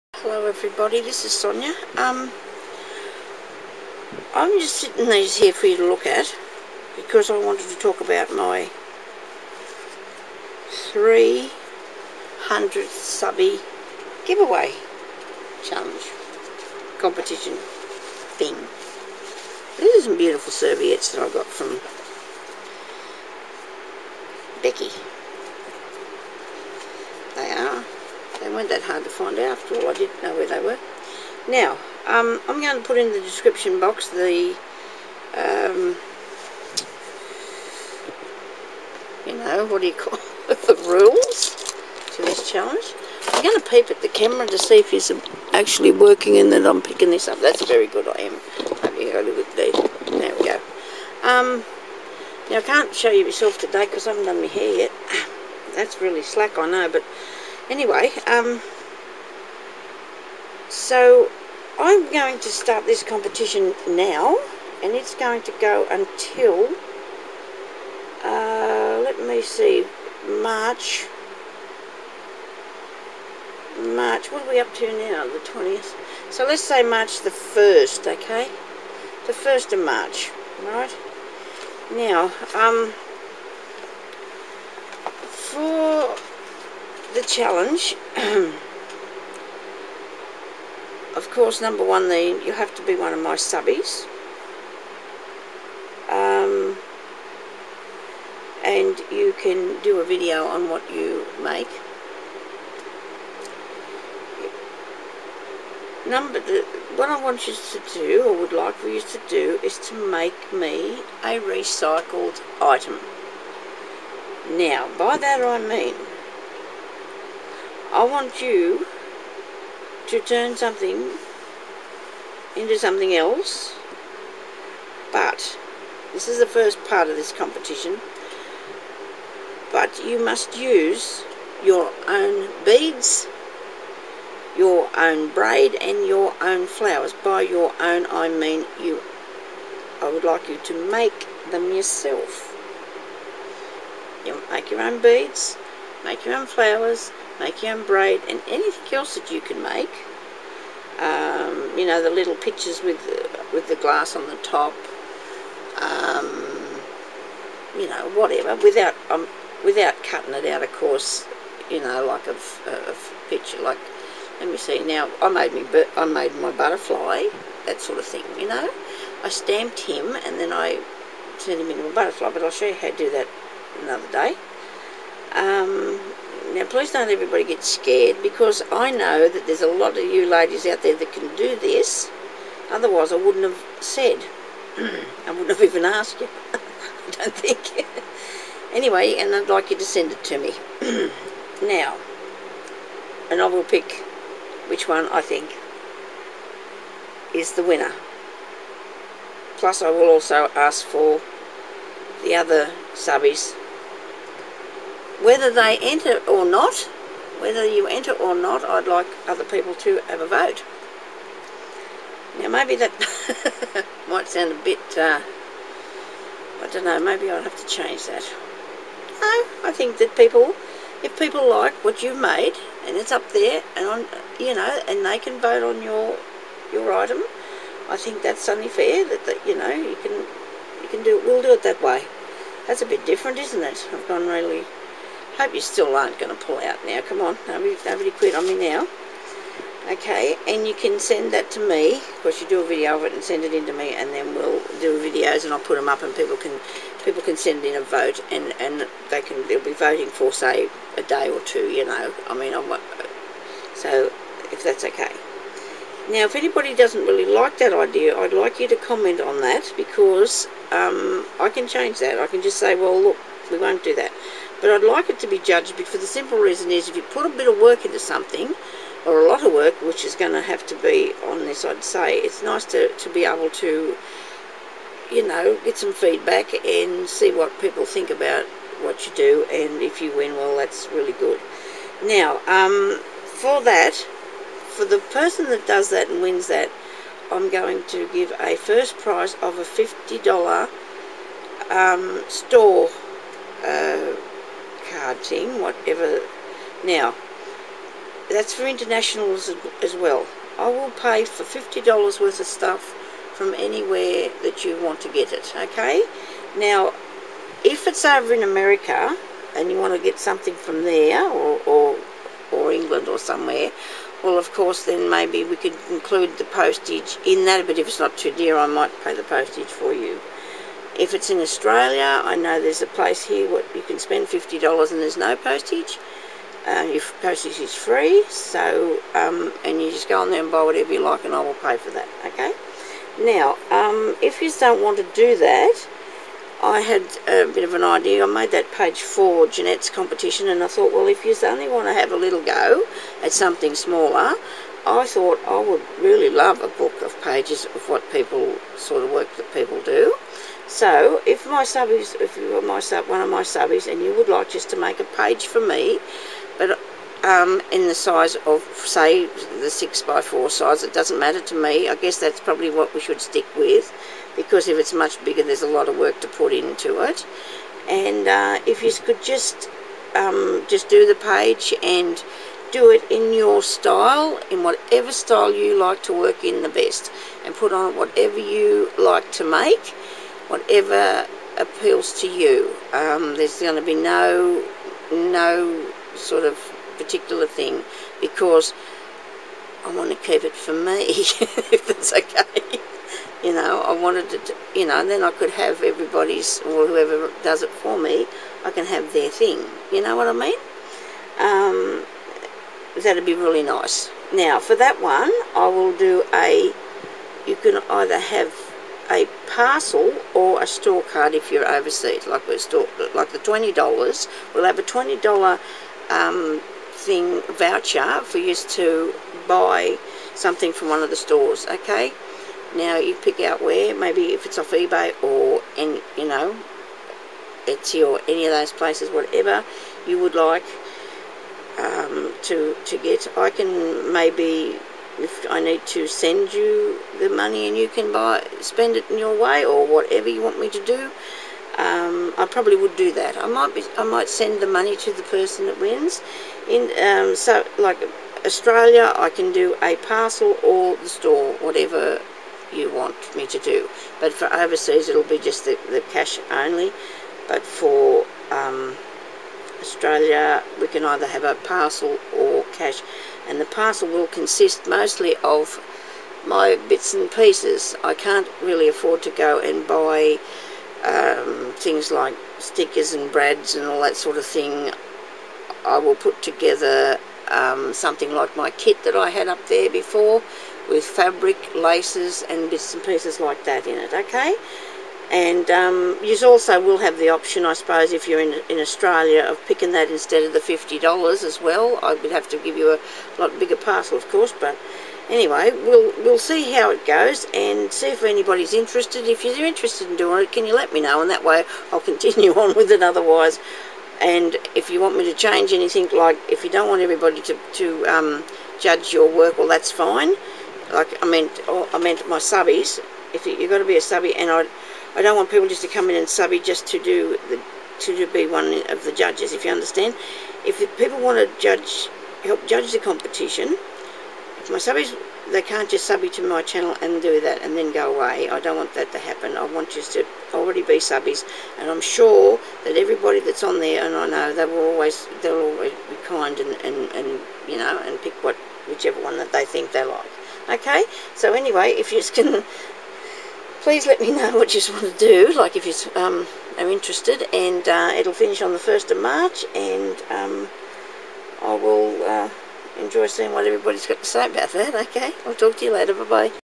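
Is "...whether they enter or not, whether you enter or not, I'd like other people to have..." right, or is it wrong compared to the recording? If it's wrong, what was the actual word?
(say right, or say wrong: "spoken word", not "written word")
right.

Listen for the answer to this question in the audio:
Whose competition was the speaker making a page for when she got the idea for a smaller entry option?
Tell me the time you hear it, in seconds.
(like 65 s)
339 s.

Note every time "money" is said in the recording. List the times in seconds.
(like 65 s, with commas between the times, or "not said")
437 s, 444 s.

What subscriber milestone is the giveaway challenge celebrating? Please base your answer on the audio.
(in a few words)
300.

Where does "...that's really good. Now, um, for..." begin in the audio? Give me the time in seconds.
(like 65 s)
280 s.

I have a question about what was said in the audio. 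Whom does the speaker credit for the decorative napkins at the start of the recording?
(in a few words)
Becky.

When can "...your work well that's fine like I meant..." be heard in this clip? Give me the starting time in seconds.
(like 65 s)
509 s.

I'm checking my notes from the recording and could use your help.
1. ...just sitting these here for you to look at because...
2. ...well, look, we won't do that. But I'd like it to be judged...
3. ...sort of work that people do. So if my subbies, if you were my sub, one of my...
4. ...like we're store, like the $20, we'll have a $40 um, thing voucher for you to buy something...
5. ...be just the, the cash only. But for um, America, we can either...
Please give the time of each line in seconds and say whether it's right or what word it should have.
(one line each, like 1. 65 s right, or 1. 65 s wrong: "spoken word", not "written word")
1. 4 s right
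2. 262 s right
3. 348 s right
4. 412 s wrong: "20", not "40"
5. 455 s wrong: "Australia", not "America".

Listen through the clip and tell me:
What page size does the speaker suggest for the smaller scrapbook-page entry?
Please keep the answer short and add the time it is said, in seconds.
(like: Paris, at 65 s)
6 by 4, at 359 s.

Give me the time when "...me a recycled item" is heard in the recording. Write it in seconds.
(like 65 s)
110 s.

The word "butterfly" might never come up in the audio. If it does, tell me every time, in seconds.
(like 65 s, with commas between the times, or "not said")
166 s, 171 s.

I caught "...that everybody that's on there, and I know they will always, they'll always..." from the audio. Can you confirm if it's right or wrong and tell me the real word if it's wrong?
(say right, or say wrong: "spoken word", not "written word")
right.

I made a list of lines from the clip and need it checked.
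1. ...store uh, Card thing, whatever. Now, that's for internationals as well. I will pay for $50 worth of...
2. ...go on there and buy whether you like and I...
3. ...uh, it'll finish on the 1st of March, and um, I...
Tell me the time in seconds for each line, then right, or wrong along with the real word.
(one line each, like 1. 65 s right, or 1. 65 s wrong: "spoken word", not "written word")
1. 292 s right
2. 330 s wrong: "whatever", not "whether"
3. 547 s right.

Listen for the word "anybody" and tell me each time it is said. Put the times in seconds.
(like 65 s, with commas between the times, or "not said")
256 s, 498 s.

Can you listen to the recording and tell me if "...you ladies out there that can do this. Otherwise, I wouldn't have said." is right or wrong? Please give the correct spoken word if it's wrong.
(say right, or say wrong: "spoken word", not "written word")
right.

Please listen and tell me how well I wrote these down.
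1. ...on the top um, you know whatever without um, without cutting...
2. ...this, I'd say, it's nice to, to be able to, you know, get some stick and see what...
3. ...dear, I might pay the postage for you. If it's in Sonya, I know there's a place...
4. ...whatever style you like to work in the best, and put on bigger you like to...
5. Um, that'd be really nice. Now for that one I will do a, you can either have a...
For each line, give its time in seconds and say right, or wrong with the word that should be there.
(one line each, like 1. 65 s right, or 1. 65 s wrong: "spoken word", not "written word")
1. 154 s right
2. 271 s wrong: "feedback", not "stick"
3. 318 s wrong: "Australia", not "Sonya"
4. 374 s wrong: "whatever", not "bigger"
5. 401 s right.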